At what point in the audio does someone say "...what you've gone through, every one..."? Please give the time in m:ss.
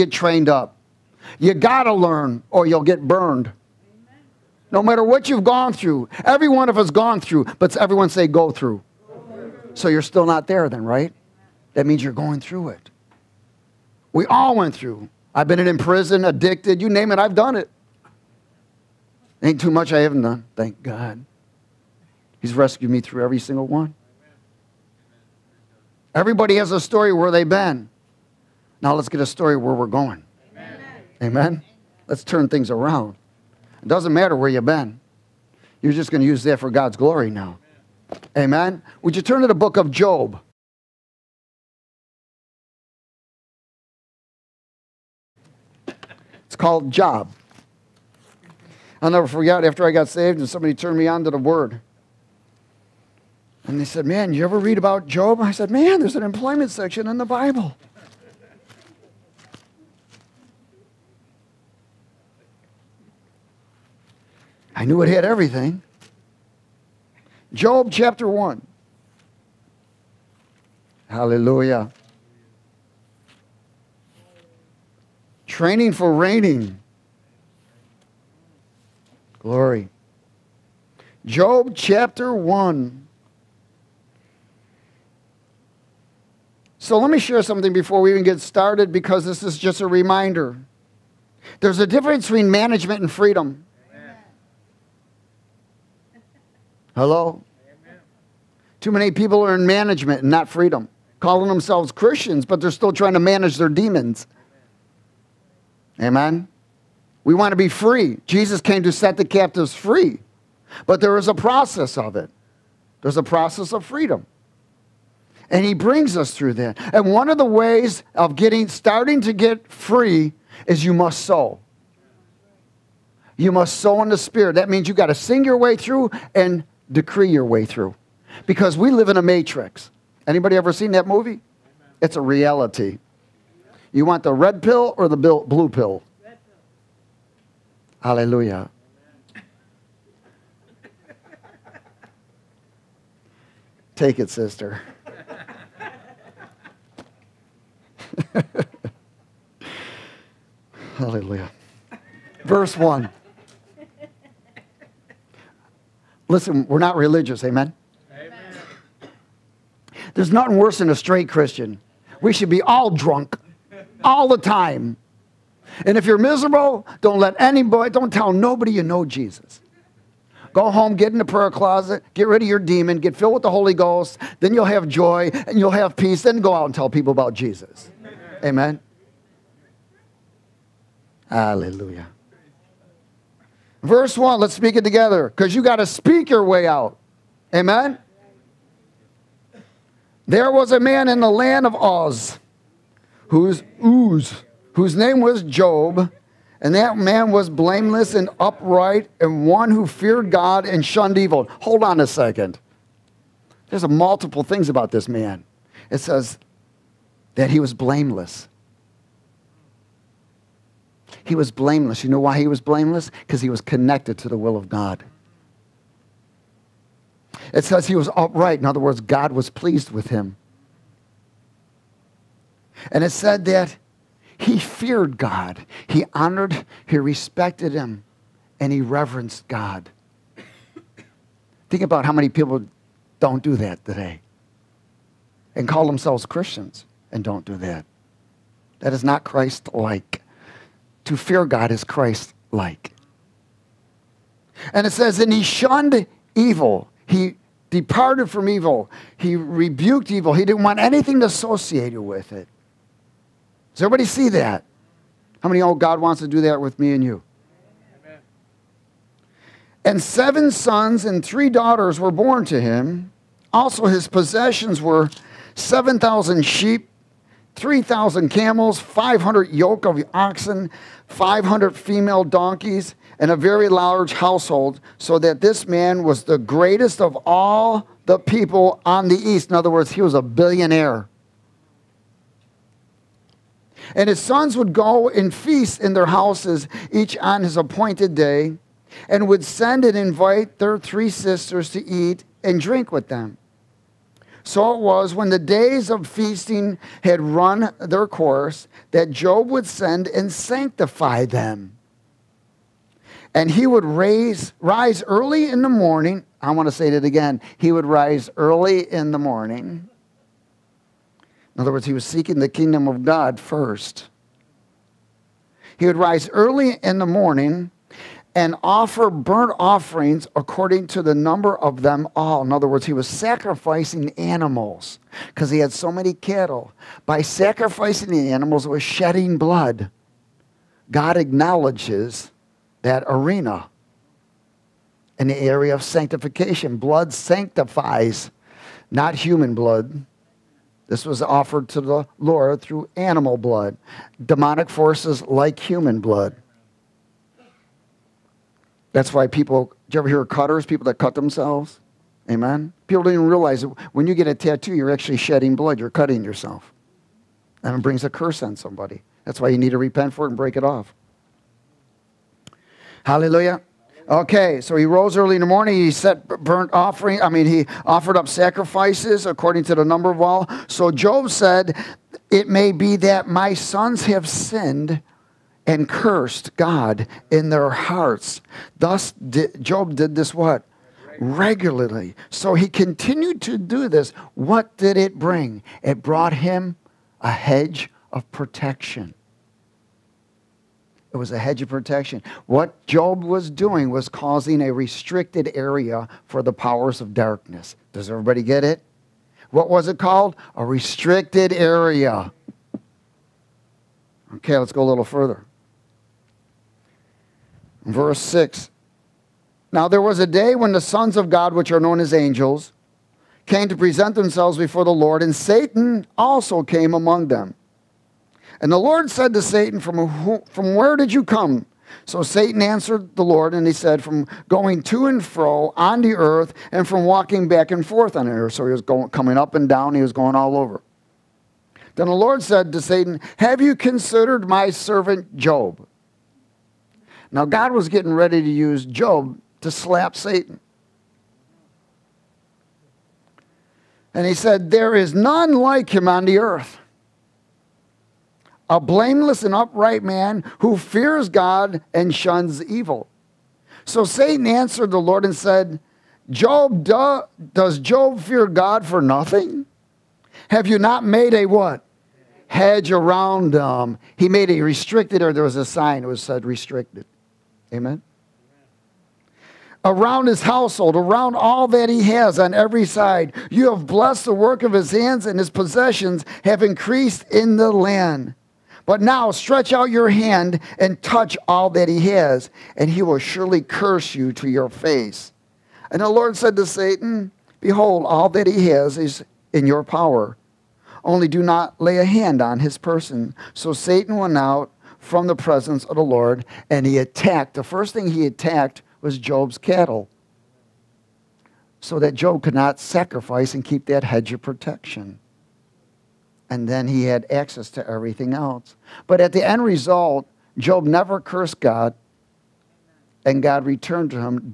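0:05.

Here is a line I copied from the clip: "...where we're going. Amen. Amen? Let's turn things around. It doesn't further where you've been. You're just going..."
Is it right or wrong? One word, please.
wrong.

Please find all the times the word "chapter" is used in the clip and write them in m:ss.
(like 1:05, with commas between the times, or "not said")
1:07, 1:21.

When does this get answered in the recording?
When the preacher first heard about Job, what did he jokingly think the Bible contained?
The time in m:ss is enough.
0:56.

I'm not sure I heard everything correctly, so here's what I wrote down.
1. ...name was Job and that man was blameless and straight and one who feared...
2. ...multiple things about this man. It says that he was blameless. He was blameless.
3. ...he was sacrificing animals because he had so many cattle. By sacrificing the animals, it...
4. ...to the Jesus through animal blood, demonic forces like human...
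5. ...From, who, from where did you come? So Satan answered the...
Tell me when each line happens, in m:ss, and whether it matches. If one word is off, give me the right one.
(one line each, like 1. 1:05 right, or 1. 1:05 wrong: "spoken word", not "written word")
1. 3:14 wrong: "upright", not "straight"
2. 3:23 right
3. 5:22 right
4. 5:41 wrong: "Lord", not "Jesus"
5. 6:59 right.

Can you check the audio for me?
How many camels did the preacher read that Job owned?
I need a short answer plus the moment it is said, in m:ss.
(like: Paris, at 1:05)
3,000, at 4:27.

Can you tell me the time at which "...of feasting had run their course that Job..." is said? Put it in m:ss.
4:55.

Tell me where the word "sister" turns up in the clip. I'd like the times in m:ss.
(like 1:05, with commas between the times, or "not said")
2:24, 4:51.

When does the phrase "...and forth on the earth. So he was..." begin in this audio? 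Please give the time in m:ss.
7:07.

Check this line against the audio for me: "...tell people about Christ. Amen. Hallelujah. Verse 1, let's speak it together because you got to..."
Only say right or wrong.
wrong.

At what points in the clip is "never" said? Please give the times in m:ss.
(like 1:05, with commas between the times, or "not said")
0:49, 8:30.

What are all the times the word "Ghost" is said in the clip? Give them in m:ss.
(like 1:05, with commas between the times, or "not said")
2:53.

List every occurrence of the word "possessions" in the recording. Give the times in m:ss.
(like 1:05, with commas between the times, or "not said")
4:24, 7:55.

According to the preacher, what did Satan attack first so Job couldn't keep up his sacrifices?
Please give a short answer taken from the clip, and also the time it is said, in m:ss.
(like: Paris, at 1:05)
Job's cattle, at 8:19.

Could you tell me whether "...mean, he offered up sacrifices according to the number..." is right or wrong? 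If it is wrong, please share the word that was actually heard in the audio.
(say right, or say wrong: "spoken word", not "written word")
right.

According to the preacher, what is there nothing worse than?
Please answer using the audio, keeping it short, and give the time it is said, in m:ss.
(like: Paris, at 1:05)
A straight Christian, at 2:40.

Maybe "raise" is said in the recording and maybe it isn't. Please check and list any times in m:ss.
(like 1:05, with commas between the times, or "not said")
5:03.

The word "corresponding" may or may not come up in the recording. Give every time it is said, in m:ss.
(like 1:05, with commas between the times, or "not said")
not said.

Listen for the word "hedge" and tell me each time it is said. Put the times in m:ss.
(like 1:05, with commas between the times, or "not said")
6:27, 6:31, 7:42, 8:24.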